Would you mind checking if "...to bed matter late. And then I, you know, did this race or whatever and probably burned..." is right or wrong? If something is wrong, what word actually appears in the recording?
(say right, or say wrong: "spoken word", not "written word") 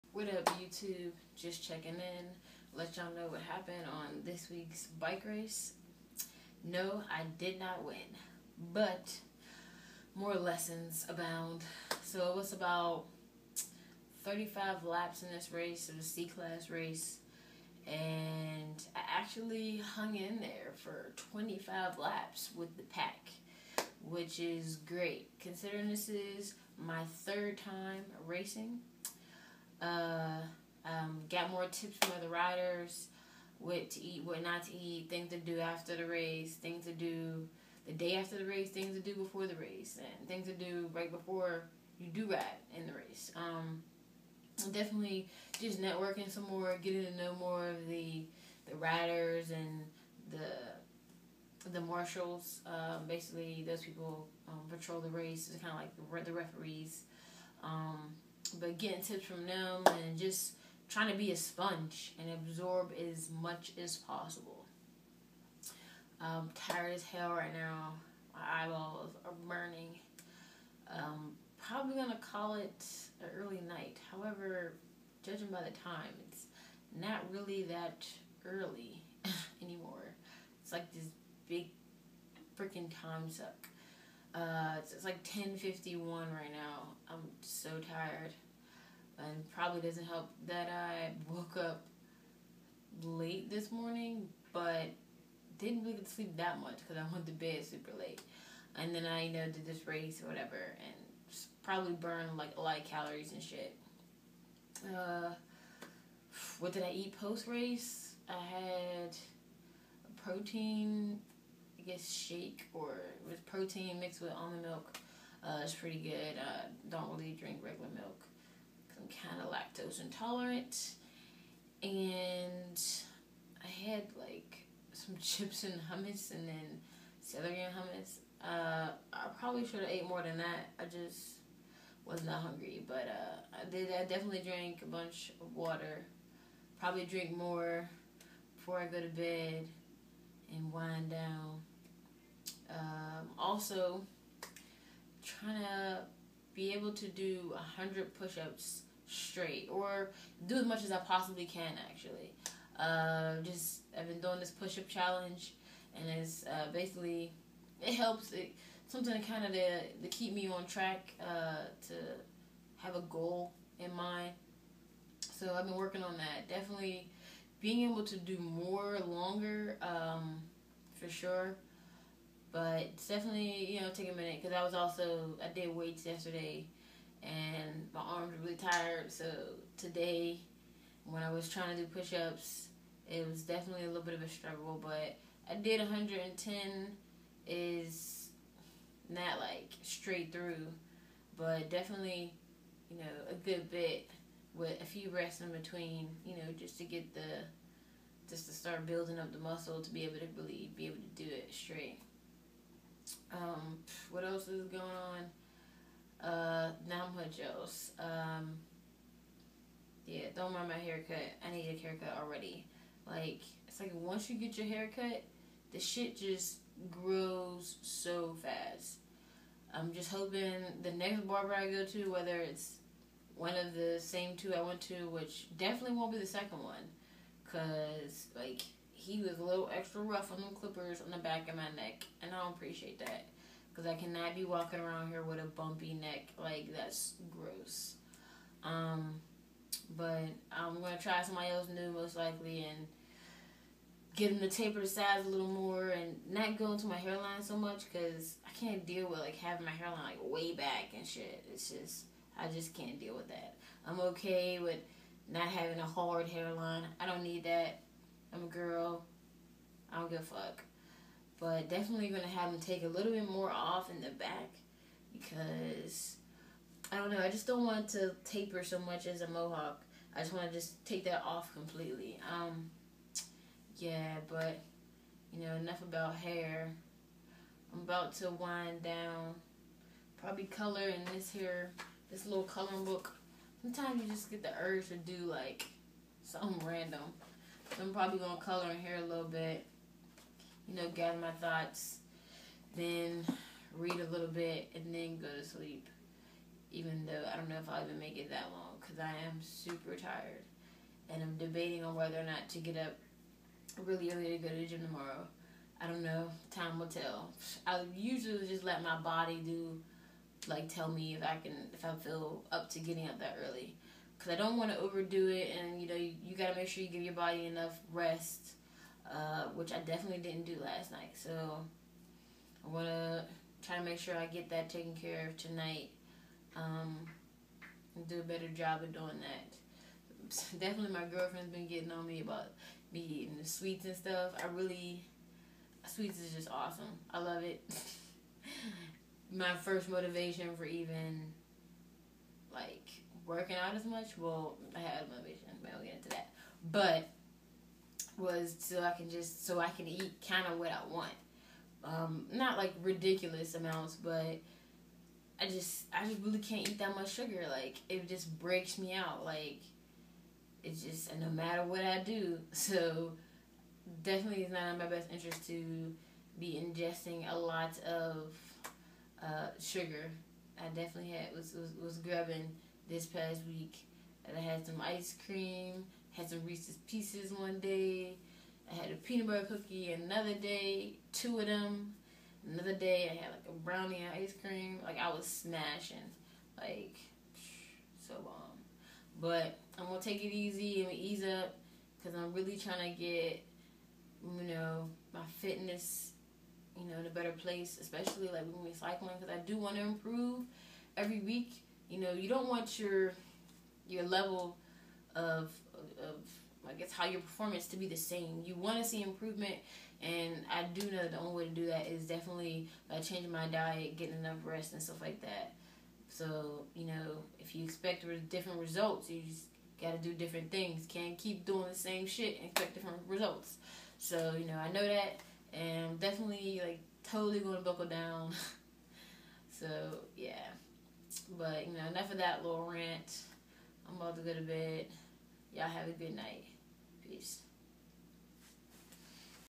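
wrong: "super", not "matter".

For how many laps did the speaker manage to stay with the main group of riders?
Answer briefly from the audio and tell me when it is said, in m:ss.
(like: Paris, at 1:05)
25, at 0:21.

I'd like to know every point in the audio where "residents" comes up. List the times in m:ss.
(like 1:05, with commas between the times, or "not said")
not said.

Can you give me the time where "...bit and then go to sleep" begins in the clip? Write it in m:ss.
4:54.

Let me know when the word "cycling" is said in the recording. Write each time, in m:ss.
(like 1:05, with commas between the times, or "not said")
6:38.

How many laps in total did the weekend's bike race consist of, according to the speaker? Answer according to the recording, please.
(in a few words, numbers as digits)
35.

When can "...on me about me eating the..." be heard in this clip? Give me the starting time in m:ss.
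5:31.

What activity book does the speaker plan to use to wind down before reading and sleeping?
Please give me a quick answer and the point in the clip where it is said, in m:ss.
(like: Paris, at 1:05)
coloring book, at 4:42.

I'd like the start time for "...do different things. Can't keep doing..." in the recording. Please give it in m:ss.
7:00.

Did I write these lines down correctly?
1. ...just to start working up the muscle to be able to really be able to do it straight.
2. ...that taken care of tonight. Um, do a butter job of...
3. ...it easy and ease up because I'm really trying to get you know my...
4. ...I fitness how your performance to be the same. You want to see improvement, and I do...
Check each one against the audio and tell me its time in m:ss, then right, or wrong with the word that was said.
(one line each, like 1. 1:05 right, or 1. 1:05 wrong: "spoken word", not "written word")
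1. 3:18 wrong: "building", not "working"
2. 5:24 wrong: "better", not "butter"
3. 6:30 right
4. 6:46 wrong: "guess", not "fitness".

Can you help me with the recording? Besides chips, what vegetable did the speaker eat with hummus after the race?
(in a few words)
celery.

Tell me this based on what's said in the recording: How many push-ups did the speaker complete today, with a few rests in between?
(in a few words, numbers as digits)
110.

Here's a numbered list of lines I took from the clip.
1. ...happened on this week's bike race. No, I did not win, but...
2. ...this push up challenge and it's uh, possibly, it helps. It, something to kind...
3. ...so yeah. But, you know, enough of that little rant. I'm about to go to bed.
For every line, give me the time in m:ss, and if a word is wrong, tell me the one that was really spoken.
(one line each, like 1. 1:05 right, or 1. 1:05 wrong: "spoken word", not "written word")
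1. 0:03 right
2. 2:34 wrong: "basically", not "possibly"
3. 7:09 right.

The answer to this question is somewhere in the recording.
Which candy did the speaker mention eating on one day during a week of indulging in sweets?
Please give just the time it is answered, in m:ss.
6:16.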